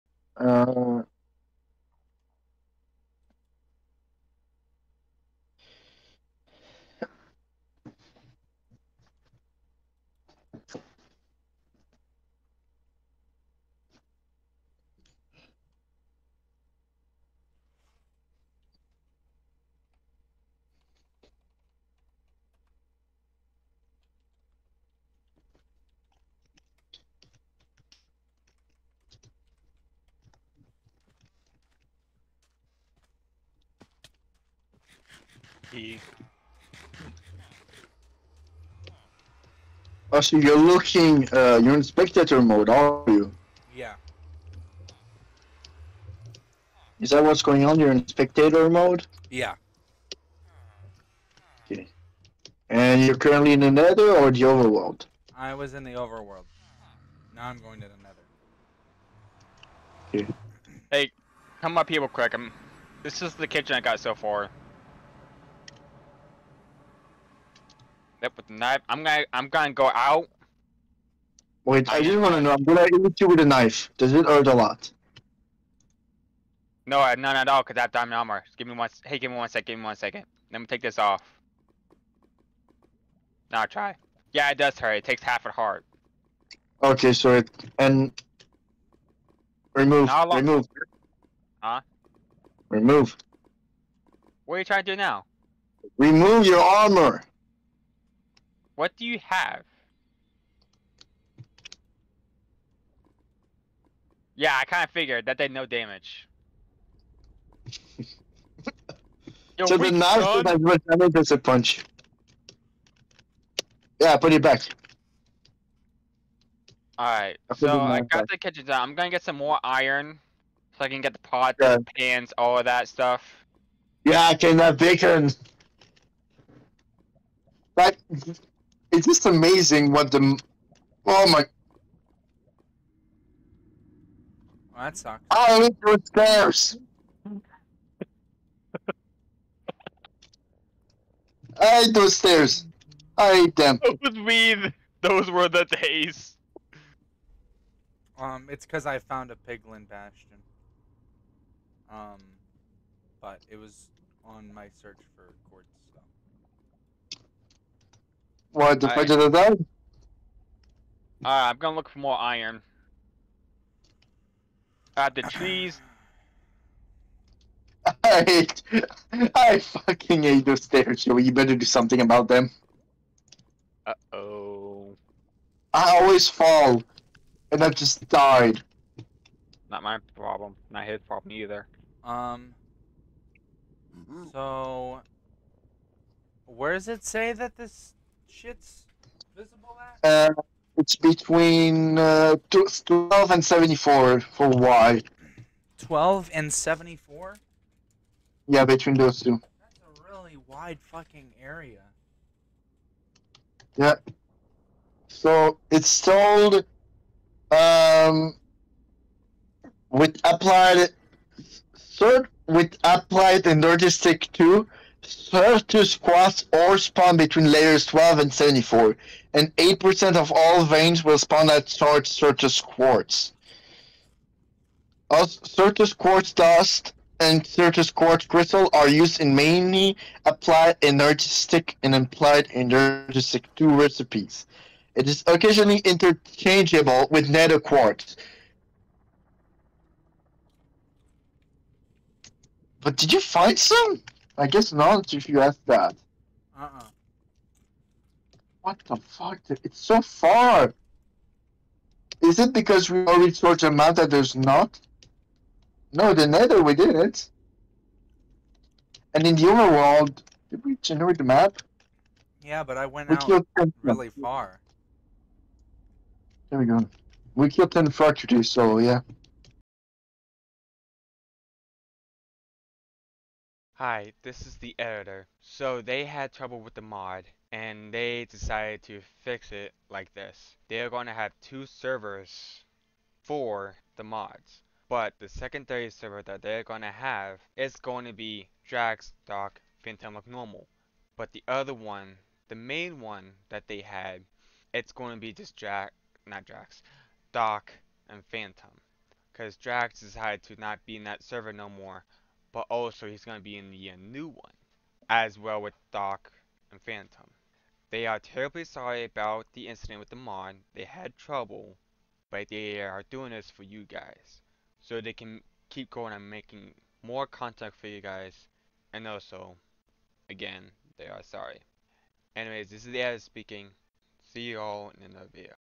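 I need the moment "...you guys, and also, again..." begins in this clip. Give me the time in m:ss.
5:17.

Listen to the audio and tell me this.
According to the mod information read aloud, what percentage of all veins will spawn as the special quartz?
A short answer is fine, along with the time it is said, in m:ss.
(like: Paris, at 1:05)
8%, at 3:39.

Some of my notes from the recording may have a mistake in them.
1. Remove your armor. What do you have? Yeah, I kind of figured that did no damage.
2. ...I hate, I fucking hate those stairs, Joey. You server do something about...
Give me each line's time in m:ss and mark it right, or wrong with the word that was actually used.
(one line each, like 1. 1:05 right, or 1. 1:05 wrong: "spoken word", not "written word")
1. 1:35 right
2. 2:48 wrong: "better", not "server".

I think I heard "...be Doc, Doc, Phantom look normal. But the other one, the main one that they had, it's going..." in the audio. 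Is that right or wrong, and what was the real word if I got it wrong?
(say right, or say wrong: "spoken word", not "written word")
wrong: "Draxx", not "Doc".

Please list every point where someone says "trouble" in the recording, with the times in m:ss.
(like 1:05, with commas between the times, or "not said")
4:36, 5:11.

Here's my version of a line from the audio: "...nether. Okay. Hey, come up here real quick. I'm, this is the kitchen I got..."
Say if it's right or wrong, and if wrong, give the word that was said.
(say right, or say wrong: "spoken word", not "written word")
right.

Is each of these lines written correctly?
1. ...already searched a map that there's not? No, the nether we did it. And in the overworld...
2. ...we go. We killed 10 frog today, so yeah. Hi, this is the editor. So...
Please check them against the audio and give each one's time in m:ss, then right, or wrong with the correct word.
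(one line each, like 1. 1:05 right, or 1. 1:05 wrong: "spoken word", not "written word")
1. 4:13 right
2. 4:26 right.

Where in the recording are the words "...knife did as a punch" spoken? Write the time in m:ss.
1:49.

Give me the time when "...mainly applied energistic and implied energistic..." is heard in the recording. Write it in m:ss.
3:49.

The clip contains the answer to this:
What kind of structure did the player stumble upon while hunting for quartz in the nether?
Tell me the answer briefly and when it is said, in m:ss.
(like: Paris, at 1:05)
piglin bastion, at 2:29.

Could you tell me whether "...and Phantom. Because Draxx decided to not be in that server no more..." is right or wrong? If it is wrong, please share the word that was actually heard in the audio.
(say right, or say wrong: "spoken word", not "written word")
right.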